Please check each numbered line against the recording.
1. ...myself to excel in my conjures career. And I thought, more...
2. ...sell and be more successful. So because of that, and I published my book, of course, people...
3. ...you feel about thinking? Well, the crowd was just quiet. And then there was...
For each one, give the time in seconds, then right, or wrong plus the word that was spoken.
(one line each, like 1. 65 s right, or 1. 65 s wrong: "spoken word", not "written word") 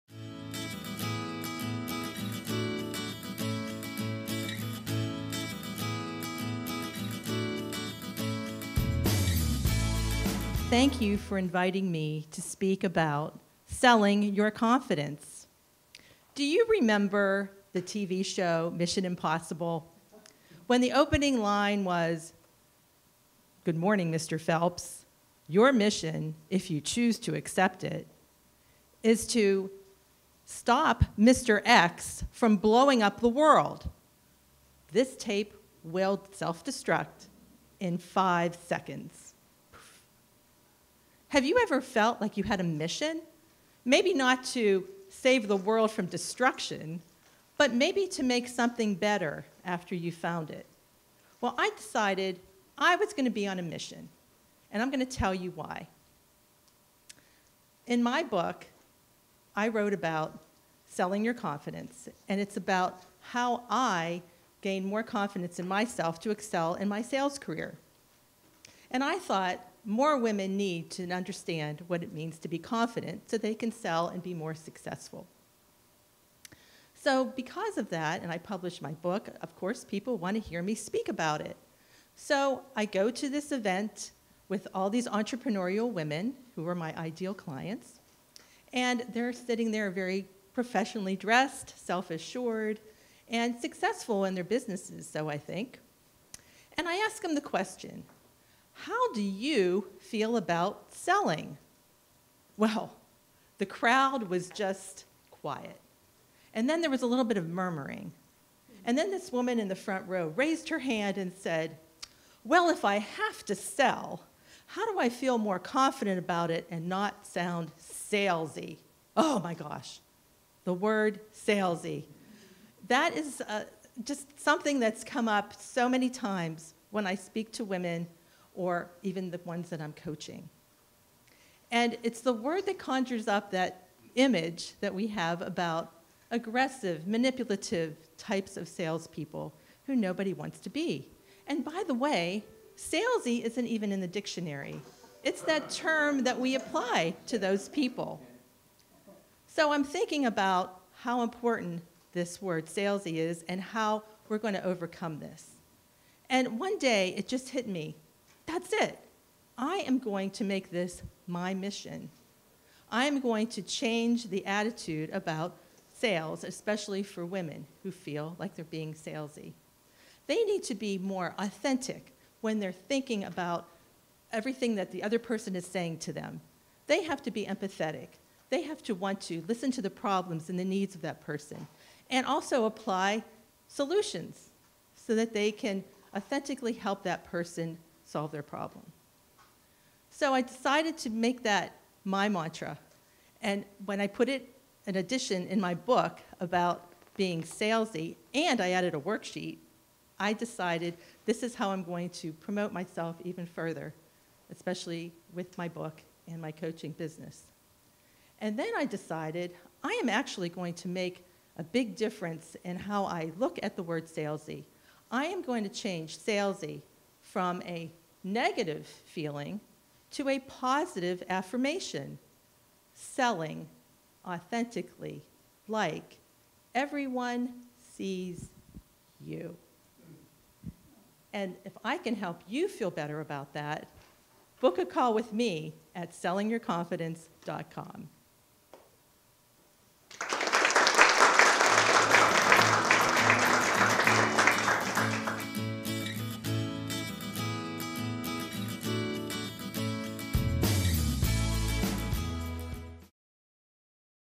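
1. 65 s wrong: "sales", not "conjures"
2. 73 s right
3. 99 s wrong: "selling", not "thinking".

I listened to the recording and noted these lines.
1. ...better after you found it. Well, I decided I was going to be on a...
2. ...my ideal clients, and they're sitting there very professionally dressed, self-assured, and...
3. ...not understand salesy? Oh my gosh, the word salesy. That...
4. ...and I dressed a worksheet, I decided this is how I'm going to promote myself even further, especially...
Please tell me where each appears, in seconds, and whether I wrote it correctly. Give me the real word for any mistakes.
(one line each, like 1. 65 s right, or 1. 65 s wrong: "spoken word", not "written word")
1. 48 s right
2. 86 s right
3. 116 s wrong: "sound", not "understand"
4. 198 s wrong: "added", not "dressed".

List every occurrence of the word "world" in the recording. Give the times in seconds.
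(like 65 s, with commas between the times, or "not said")
33 s, 45 s.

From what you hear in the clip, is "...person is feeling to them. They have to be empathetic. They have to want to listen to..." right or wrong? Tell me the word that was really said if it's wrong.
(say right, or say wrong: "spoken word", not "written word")
wrong: "saying", not "feeling".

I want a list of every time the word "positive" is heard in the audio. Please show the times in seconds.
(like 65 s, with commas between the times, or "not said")
220 s.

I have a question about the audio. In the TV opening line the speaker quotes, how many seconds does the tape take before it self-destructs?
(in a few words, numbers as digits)
5.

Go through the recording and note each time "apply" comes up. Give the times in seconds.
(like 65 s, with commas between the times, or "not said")
146 s, 182 s.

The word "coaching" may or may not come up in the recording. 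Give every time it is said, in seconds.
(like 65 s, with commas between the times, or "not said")
129 s, 206 s.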